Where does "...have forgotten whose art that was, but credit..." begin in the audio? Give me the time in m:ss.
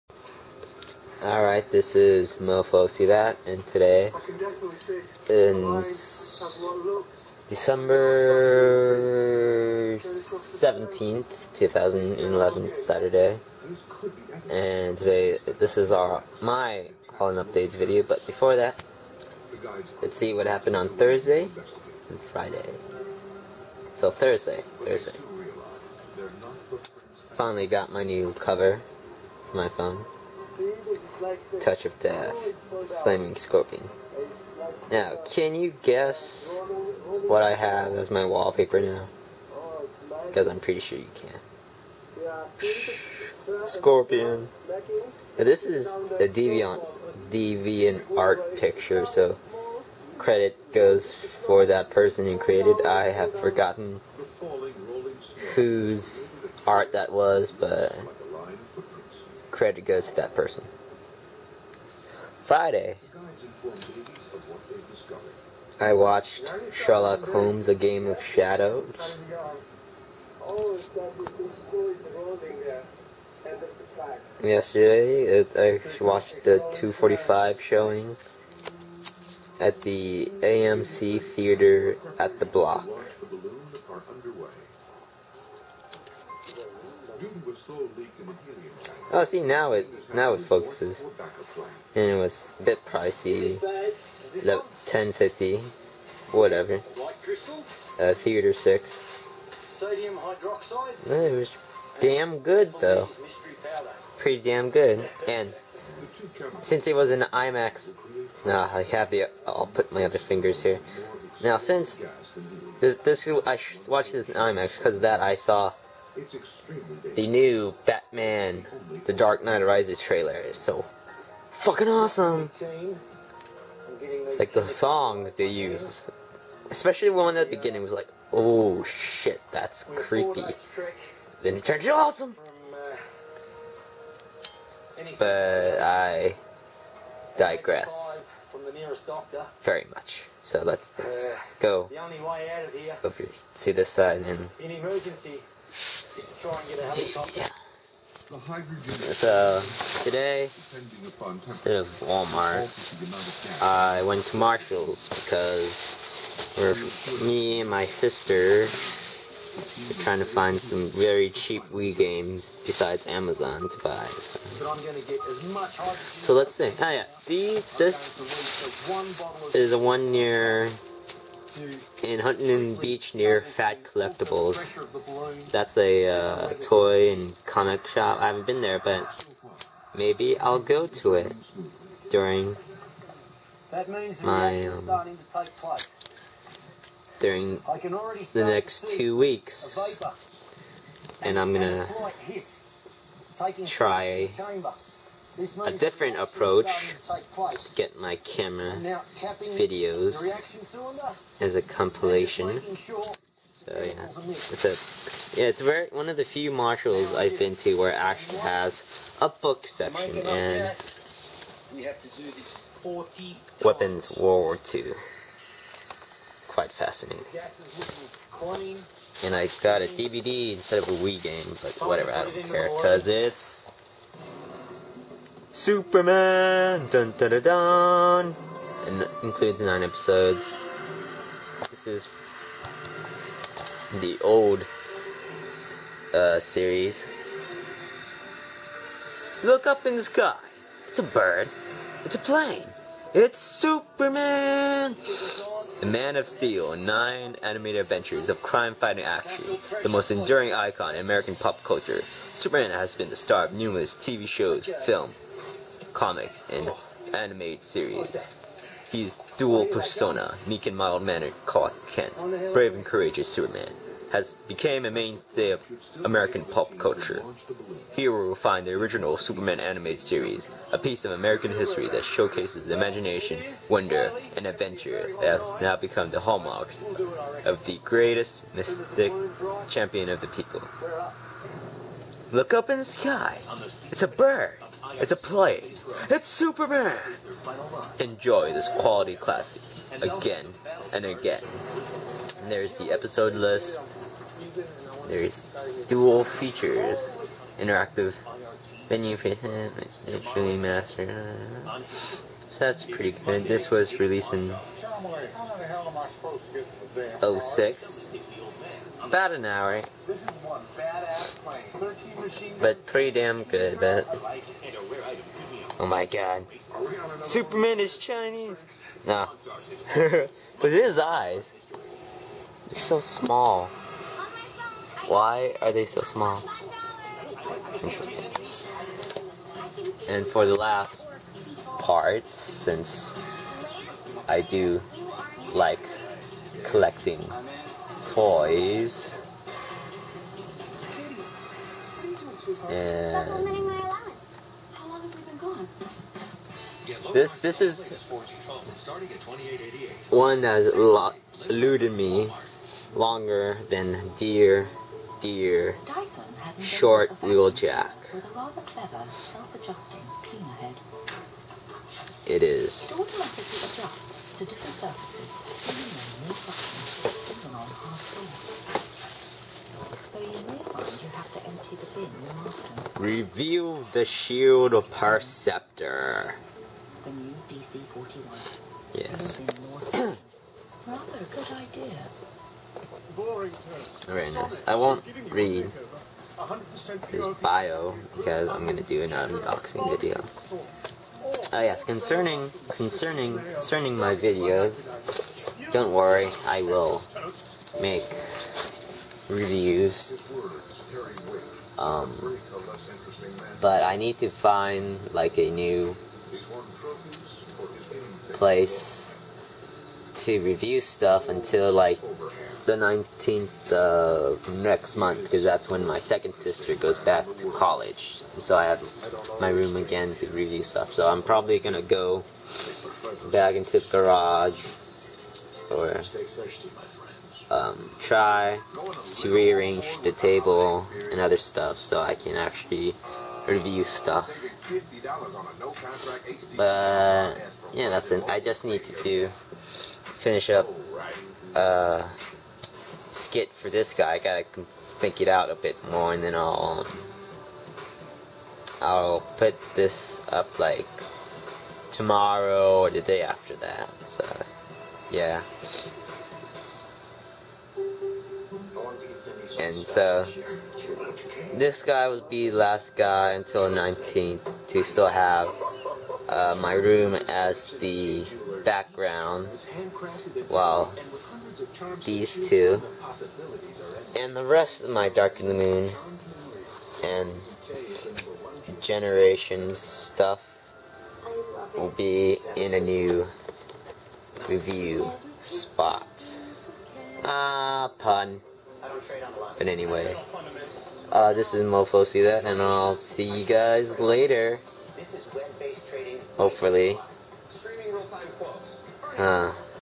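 0:53.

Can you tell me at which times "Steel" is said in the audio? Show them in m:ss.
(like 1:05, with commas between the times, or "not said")
4:06.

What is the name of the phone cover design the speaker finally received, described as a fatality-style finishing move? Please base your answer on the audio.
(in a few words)
Touch of Death, Flaming Scorpion.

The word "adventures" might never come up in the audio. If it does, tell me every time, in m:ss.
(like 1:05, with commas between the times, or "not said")
4:07, 4:34.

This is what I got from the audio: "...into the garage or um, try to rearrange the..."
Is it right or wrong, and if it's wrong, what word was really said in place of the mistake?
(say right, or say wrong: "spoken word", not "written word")
right.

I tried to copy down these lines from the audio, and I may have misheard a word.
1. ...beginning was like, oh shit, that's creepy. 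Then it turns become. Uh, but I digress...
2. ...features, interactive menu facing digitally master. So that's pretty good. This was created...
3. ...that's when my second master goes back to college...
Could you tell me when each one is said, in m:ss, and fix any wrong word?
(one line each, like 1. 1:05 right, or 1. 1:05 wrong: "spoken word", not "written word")
1. 2:07 wrong: "awesome", not "become"
2. 4:56 wrong: "released", not "created"
3. 6:55 wrong: "sister", not "master".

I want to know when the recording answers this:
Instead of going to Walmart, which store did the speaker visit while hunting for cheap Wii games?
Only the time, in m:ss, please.
2:34.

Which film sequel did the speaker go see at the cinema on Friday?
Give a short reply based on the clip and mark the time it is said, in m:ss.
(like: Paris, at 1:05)
Sherlock Holmes, A Game of Shadows, at 1:06.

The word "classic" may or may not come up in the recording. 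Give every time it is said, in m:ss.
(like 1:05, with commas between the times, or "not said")
4:49.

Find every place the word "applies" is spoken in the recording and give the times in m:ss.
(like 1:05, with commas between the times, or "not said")
not said.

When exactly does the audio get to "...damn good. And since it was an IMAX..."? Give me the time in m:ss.
1:44.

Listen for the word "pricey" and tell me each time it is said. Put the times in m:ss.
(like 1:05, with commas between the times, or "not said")
1:32.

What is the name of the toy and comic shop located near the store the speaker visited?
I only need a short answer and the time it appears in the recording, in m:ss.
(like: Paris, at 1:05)
Fat Collectibles, at 2:53.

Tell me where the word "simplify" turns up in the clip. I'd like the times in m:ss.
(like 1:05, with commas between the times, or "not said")
not said.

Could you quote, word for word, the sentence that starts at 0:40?
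Because I'm pretty sure you can.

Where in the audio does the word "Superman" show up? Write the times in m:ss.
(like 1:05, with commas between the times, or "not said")
3:45, 4:03, 4:12, 4:23, 4:29, 4:46, 5:17.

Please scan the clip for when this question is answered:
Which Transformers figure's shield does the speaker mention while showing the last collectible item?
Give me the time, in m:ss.
6:14.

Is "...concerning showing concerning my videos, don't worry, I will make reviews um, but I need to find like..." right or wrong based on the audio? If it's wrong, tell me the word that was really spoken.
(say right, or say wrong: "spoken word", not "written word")
wrong: "concerning", not "showing".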